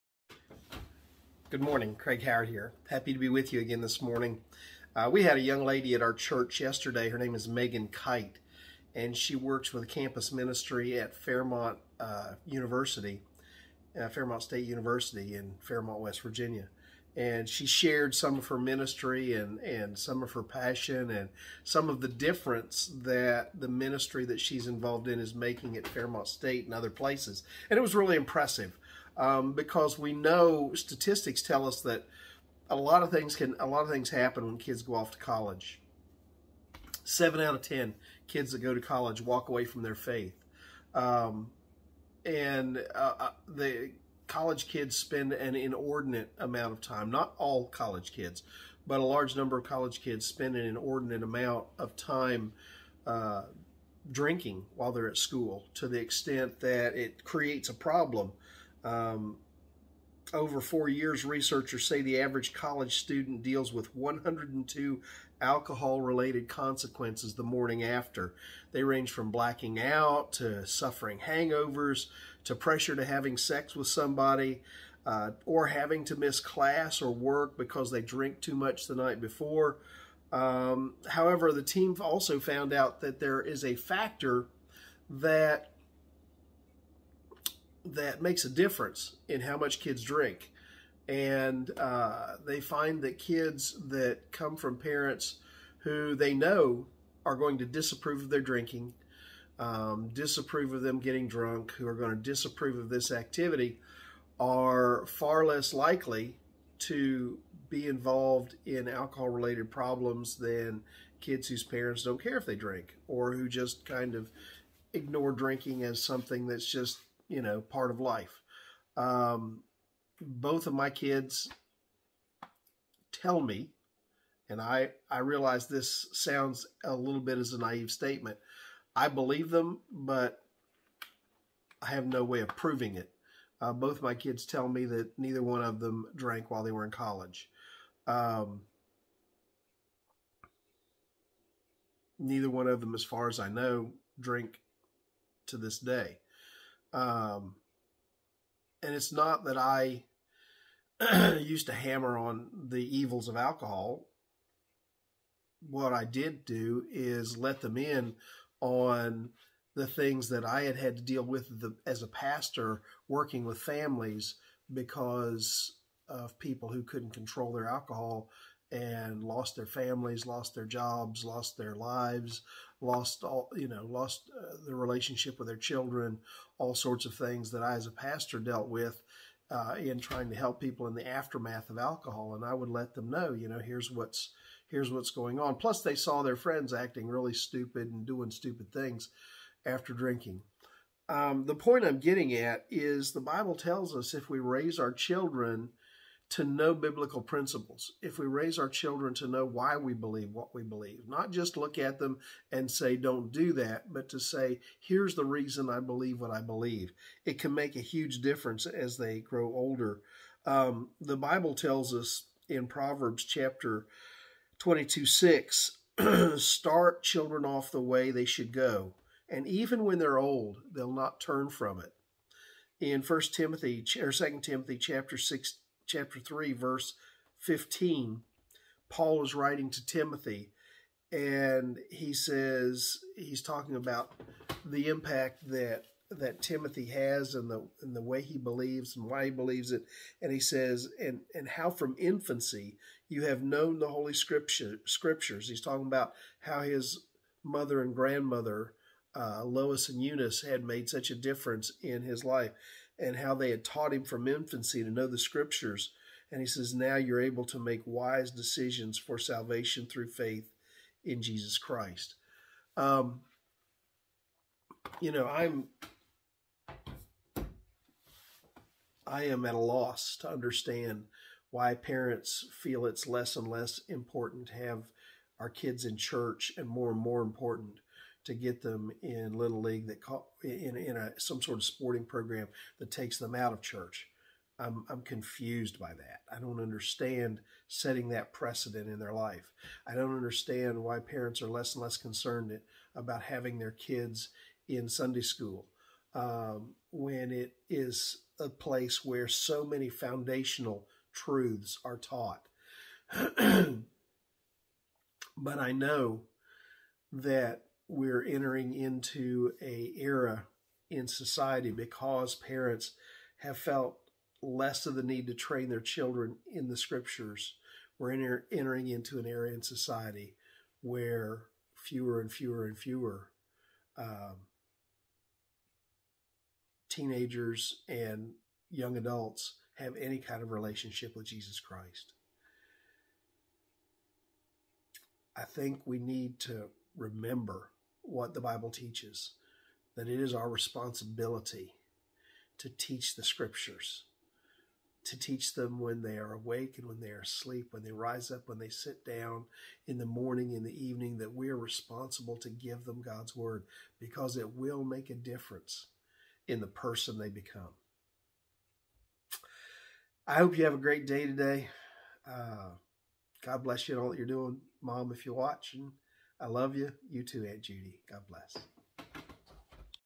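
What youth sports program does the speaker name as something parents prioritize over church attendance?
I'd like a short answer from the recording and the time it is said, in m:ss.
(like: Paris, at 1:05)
Little league, at 4:39.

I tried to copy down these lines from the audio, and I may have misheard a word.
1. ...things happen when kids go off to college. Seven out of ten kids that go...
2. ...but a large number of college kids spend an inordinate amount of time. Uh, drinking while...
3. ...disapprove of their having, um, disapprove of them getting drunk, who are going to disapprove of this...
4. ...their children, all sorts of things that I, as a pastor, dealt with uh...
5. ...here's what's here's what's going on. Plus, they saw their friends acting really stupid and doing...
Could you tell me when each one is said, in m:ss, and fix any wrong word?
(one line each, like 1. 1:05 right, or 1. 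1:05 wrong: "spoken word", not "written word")
1. 0:33 right
2. 0:48 right
3. 1:37 wrong: "drinking", not "having"
4. 2:55 right
5. 3:03 right.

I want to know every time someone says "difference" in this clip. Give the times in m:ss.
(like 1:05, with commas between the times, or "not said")
0:22, 1:28, 3:28, 4:11, 5:55.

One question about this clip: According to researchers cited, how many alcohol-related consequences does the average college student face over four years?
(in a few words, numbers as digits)
102.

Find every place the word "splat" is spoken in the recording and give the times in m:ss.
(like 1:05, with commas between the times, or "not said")
not said.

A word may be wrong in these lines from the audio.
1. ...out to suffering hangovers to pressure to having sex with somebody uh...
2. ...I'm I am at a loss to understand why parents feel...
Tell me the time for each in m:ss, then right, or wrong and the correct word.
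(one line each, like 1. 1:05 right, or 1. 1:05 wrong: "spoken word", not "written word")
1. 1:09 right
2. 4:25 right.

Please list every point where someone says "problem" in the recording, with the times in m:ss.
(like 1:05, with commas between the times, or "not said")
0:57, 1:49.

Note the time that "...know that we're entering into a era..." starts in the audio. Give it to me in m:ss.
5:05.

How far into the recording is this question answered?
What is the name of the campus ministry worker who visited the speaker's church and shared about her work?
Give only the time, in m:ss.
0:07.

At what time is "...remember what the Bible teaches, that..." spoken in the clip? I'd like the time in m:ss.
5:36.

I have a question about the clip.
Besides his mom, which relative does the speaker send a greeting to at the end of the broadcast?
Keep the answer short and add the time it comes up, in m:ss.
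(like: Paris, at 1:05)
Aunt Judy, at 6:07.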